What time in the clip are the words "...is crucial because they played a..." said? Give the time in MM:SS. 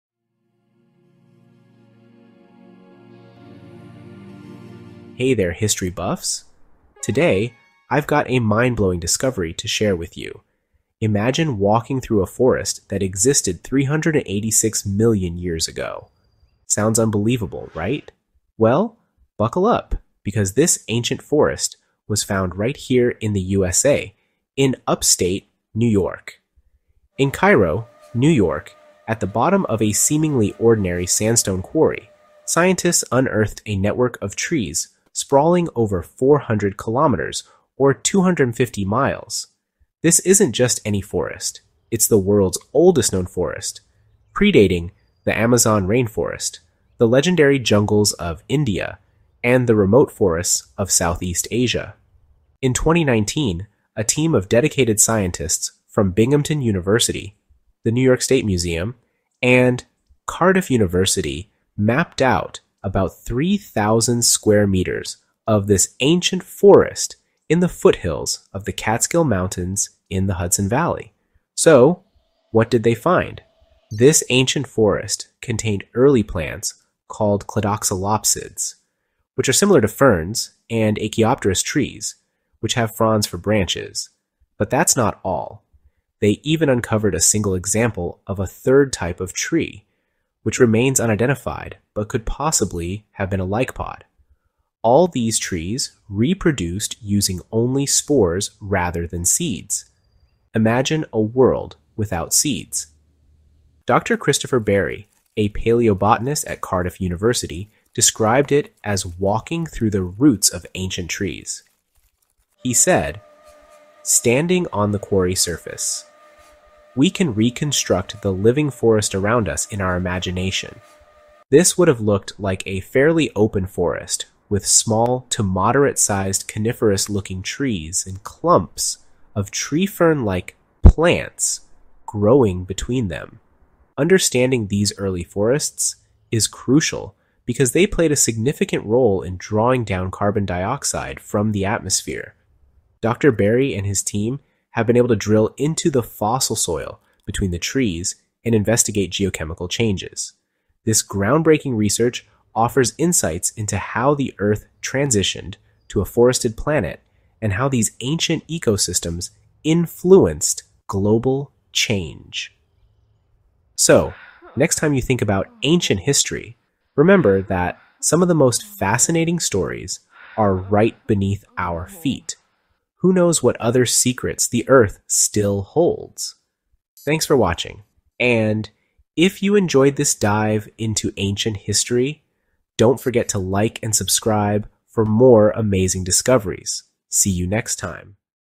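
02:16.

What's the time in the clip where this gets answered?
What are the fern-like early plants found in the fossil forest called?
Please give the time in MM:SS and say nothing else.
01:17.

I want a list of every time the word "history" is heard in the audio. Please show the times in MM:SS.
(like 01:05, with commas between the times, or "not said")
00:05, 02:46, 03:01.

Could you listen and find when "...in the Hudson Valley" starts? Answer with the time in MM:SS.
01:10.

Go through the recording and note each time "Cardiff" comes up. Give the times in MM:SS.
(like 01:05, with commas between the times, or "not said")
01:00, 01:46.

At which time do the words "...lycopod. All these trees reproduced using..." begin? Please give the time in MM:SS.
01:33.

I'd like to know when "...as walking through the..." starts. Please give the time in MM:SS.
01:48.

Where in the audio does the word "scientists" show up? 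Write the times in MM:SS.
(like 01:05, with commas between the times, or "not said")
00:32, 00:54.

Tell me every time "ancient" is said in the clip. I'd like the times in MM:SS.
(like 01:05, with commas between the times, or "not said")
00:20, 01:05, 01:14, 01:50, 02:38, 02:45, 03:01.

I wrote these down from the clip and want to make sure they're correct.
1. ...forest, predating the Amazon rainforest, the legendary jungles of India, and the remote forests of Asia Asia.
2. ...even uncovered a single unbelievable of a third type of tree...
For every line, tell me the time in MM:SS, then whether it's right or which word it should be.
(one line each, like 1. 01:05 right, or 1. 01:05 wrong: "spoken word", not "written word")
1. 00:43 wrong: "Southeast", not "Asia"
2. 01:26 wrong: "example", not "unbelievable".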